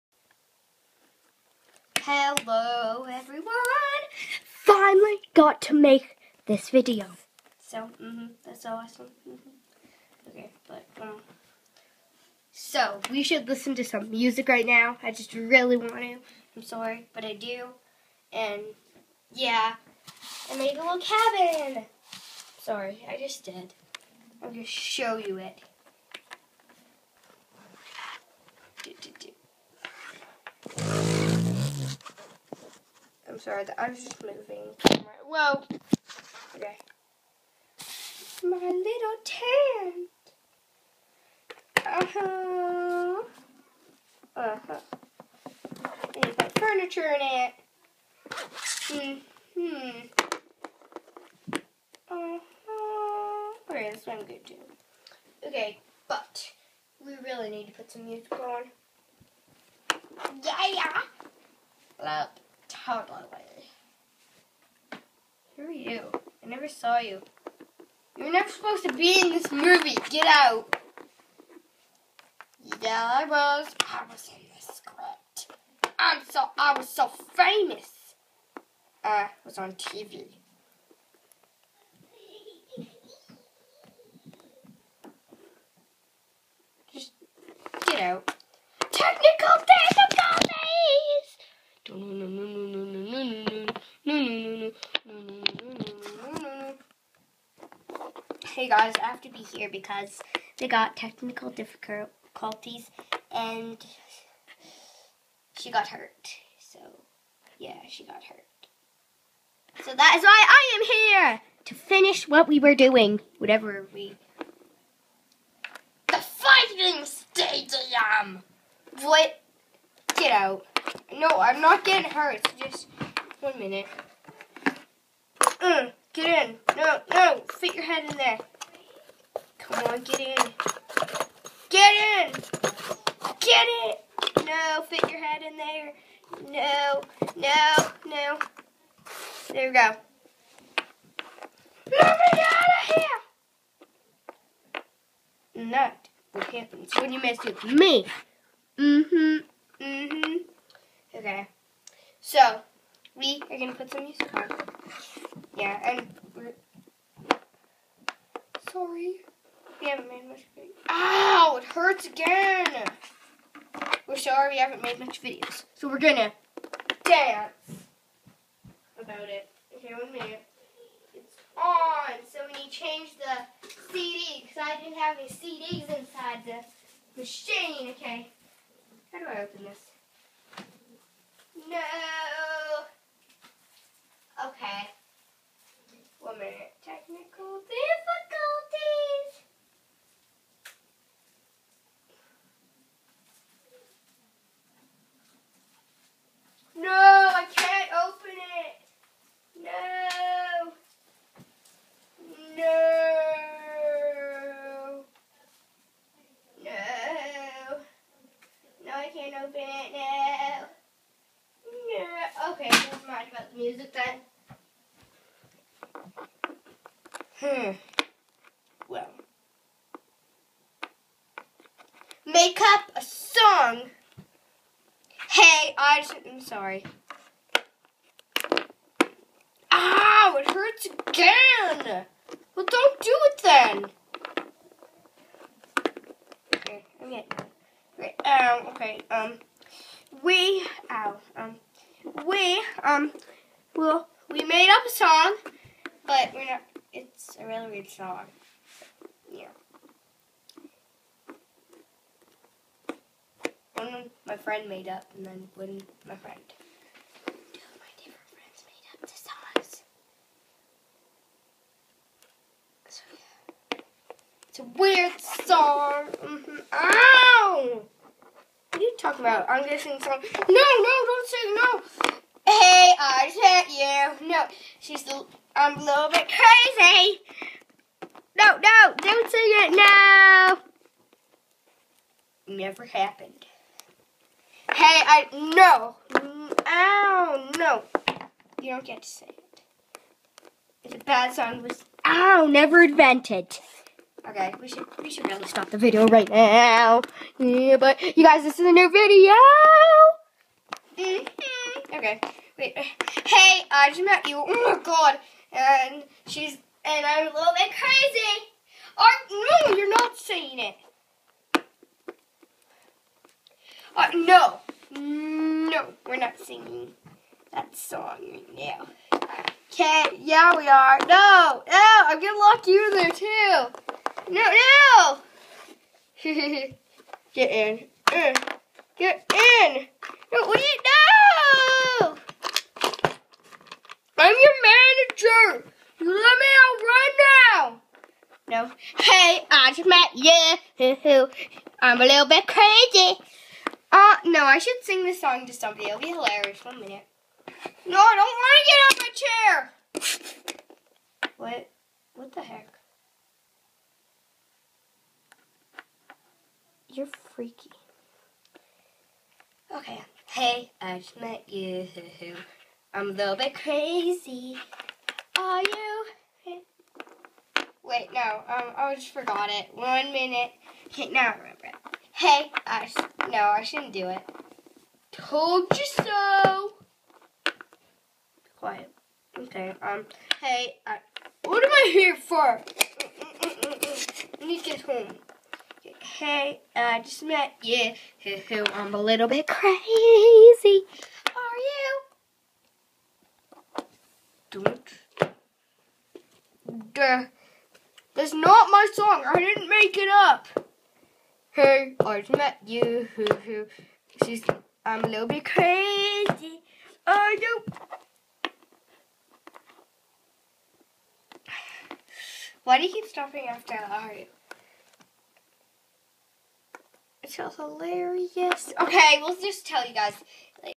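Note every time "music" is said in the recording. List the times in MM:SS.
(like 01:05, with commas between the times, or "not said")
00:14, 00:58, 02:34, 03:33.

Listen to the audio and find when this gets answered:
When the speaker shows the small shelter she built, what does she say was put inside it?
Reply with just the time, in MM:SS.
00:46.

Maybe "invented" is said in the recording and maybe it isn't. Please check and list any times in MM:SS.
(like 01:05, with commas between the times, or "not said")
04:52.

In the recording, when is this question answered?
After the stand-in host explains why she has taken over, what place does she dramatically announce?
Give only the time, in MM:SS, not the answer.
01:56.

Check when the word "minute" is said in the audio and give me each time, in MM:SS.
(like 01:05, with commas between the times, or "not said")
02:03, 02:50, 05:46, 06:10.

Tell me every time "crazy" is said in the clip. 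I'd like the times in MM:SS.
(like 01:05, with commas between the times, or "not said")
04:36, 05:07, 05:42, 06:03, 06:29, 06:45.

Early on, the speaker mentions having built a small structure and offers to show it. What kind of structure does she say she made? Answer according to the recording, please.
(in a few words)
cabin.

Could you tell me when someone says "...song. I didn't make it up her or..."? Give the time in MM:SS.
06:38.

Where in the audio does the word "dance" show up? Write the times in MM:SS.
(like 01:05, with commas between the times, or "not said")
02:47.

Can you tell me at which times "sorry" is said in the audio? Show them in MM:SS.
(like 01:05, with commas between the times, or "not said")
00:16, 00:22, 00:33, 02:38, 02:44, 03:46.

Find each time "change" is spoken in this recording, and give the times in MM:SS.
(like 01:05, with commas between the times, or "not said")
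02:52.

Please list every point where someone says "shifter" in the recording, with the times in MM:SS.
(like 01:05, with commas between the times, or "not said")
not said.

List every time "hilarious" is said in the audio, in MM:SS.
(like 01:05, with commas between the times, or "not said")
05:46, 06:57.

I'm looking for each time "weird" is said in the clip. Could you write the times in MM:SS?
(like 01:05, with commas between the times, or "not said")
04:07, 04:24.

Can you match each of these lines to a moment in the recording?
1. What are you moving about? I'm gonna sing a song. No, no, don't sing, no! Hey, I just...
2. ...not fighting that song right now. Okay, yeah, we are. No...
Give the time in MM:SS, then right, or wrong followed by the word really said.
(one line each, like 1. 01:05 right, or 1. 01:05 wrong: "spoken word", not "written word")
1. 04:28 wrong: "talking", not "moving"
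2. 05:16 wrong: "singing", not "fighting".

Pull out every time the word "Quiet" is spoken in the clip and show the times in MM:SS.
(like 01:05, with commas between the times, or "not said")
06:18.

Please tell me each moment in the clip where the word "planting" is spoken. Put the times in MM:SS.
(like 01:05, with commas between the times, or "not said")
not said.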